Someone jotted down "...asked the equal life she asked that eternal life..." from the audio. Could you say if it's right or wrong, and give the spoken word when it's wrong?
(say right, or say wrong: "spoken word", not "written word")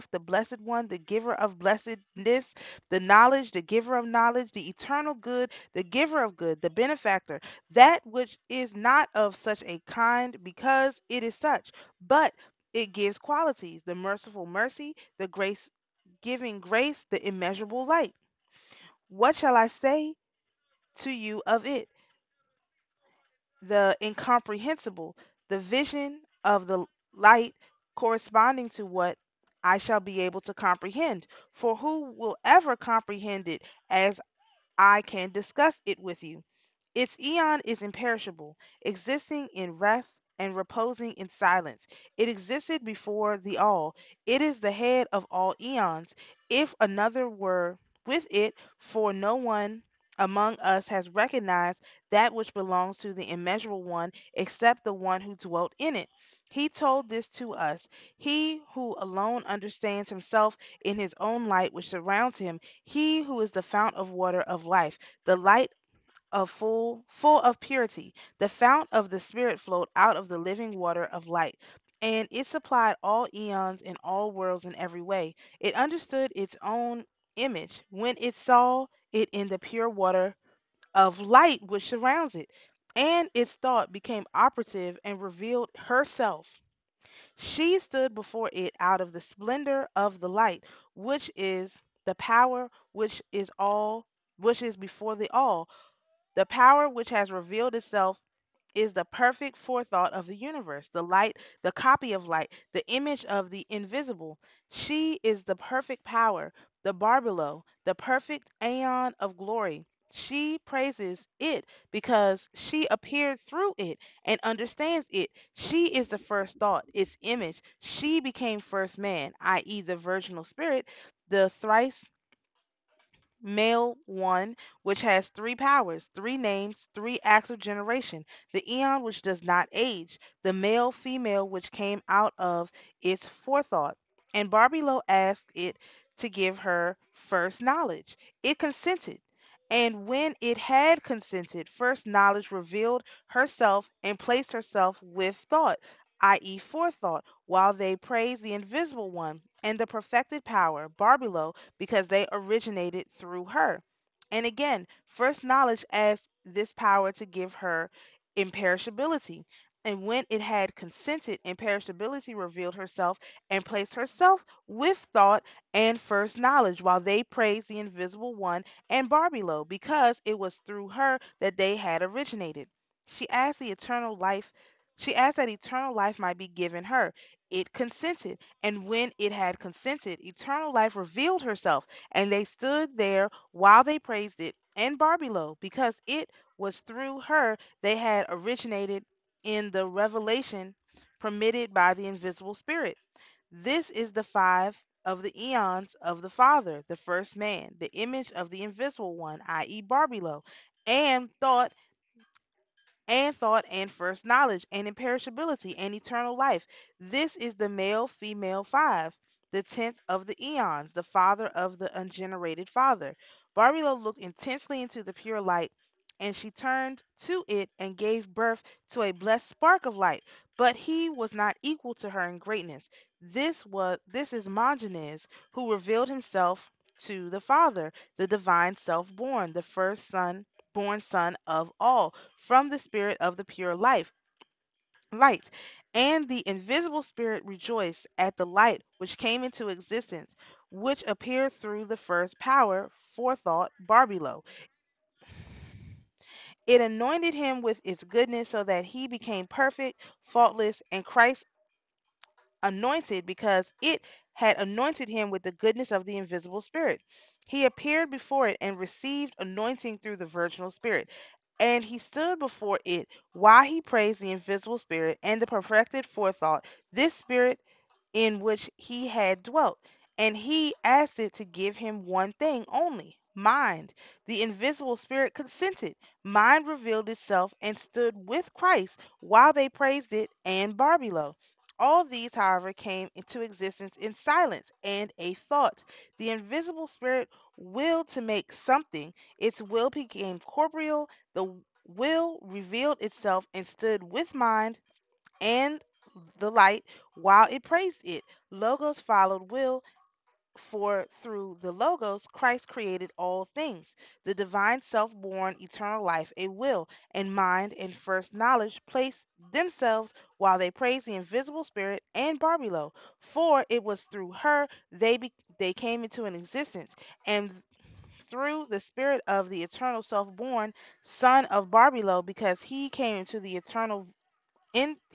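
wrong: "eternal", not "equal".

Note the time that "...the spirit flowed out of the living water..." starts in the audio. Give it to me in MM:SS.
01:09.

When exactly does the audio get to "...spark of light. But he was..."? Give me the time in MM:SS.
03:39.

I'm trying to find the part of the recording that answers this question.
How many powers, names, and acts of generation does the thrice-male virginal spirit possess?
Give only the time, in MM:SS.
02:05.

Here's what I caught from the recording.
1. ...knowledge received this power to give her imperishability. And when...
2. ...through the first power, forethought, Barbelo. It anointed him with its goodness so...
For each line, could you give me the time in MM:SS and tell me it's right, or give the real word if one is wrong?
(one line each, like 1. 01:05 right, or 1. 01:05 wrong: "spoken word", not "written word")
1. 02:35 wrong: "asked", not "received"
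2. 04:01 right.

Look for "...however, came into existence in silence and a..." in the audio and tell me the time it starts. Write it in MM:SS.
04:42.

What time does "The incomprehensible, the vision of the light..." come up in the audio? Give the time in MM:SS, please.
00:23.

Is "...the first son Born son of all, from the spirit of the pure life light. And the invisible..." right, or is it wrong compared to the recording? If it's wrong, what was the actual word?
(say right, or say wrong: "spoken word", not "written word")
right.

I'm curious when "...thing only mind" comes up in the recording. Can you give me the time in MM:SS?
04:32.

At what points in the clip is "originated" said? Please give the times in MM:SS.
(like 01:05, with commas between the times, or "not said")
02:32, 02:52, 03:08.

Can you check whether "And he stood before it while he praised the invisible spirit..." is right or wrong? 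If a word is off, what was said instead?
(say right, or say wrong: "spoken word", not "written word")
right.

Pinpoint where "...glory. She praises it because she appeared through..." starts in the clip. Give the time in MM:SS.
01:49.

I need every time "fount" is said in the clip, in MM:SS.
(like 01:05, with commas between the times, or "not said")
01:03, 01:08.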